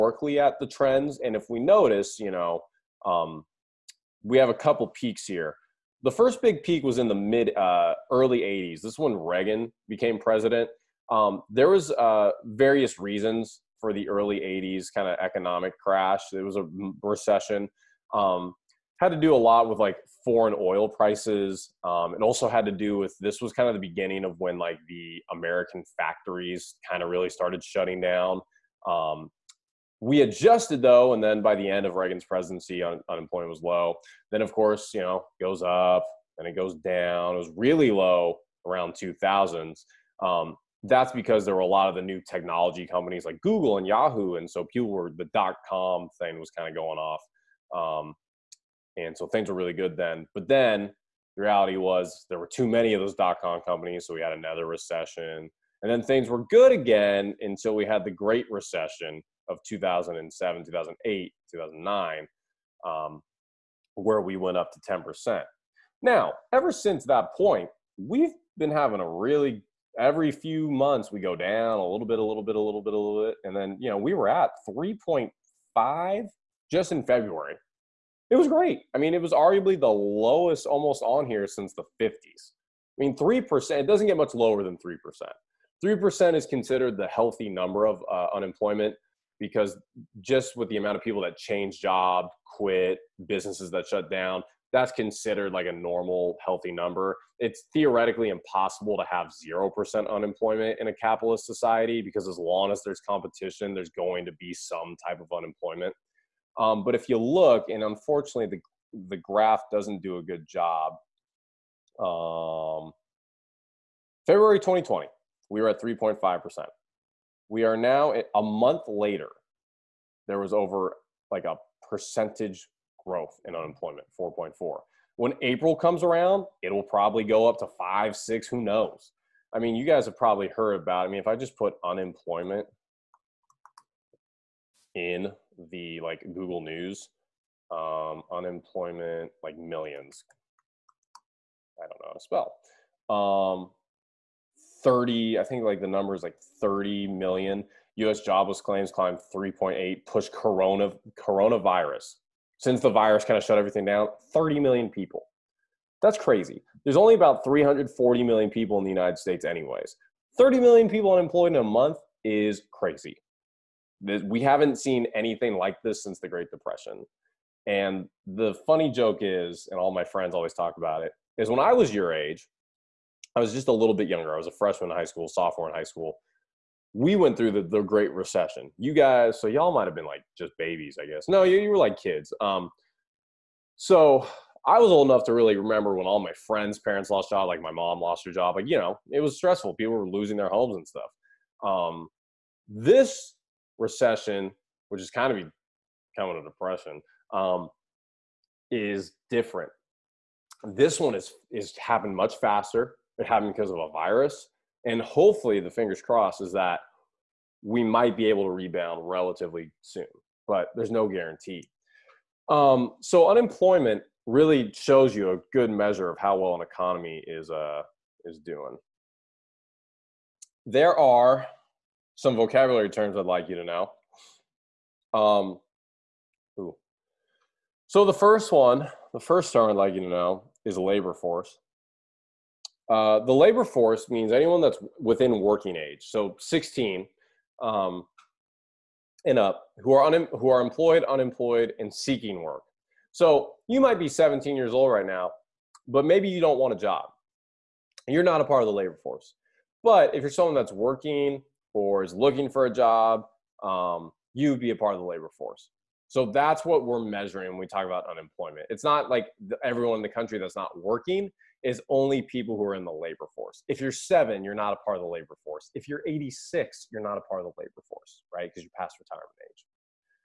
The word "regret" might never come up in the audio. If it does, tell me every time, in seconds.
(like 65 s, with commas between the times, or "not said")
not said.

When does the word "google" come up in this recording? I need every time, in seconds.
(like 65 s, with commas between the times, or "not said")
43 s, 136 s.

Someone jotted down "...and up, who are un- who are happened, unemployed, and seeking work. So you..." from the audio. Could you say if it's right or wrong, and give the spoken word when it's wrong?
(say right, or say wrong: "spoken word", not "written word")
wrong: "employed", not "happened".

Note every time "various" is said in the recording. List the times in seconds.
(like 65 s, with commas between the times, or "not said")
12 s.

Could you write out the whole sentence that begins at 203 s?
It happened because of a virus, and hopefully, the fingers crossed is that we might be able to rebound relatively soon.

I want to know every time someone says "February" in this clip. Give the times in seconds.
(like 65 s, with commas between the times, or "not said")
77 s, 114 s.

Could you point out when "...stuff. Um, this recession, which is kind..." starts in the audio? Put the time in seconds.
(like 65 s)
190 s.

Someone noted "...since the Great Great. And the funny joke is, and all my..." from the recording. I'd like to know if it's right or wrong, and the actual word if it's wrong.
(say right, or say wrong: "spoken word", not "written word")
wrong: "Depression", not "Great".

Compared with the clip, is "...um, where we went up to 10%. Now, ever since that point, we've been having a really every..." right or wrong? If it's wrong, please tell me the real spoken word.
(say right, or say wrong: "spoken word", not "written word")
right.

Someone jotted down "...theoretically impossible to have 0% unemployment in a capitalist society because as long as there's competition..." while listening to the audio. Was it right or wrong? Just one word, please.
right.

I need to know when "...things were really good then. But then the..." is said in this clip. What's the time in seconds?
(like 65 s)
49 s.